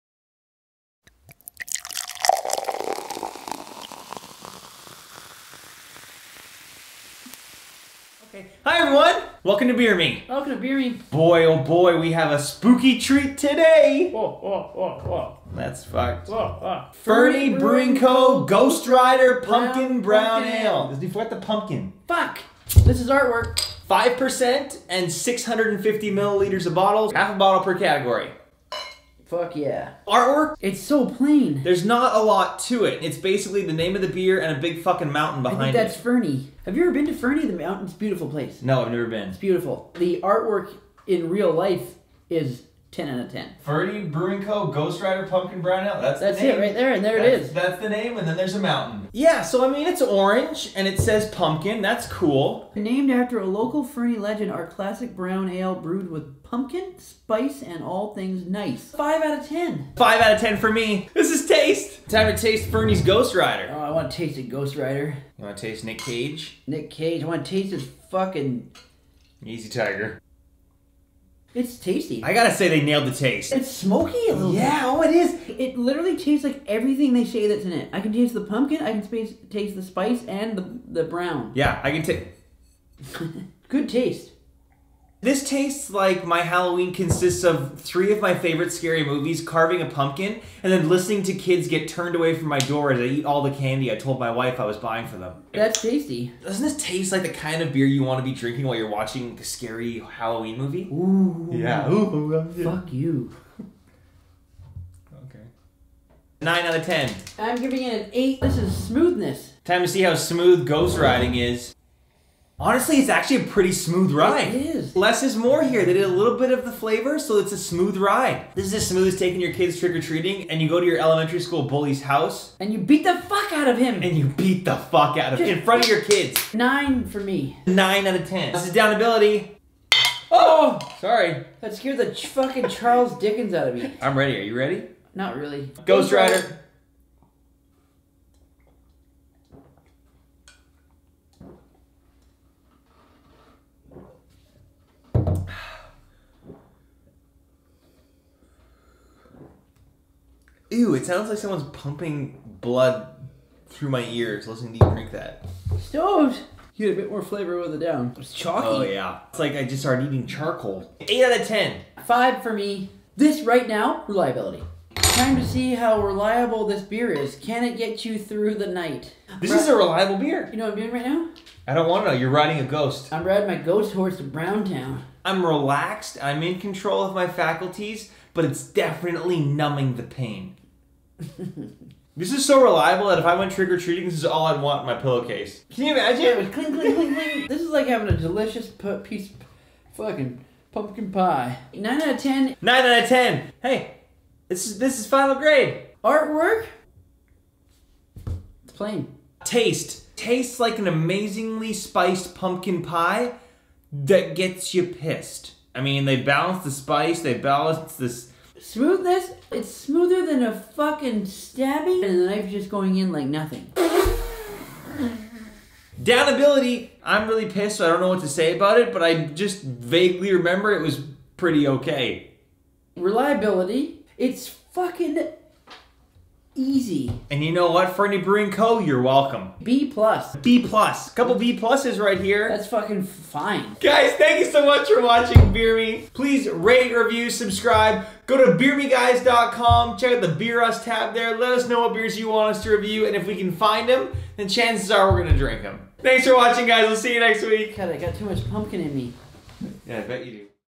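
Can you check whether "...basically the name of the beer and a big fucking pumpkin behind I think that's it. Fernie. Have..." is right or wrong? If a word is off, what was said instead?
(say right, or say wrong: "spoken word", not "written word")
wrong: "mountain", not "pumpkin".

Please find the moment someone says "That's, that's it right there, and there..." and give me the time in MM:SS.
00:46.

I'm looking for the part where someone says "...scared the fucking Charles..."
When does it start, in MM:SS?
02:11.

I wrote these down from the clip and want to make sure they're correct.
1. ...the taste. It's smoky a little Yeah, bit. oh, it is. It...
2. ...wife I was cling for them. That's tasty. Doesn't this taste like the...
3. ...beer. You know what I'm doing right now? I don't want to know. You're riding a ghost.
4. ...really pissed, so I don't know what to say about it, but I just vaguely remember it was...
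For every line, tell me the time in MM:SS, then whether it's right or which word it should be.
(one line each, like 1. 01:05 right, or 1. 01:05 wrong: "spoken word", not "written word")
1. 01:13 right
2. 01:34 wrong: "buying", not "cling"
3. 02:50 right
4. 03:37 right.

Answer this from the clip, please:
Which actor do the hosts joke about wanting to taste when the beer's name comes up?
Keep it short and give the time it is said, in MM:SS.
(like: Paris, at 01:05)
Nick Cage, at 01:05.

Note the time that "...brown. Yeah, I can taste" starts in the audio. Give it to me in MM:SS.
01:21.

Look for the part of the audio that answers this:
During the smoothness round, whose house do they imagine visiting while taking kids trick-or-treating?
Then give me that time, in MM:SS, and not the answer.
02:00.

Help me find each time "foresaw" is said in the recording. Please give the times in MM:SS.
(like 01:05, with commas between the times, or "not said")
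not said.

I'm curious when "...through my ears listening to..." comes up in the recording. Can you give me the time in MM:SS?
02:33.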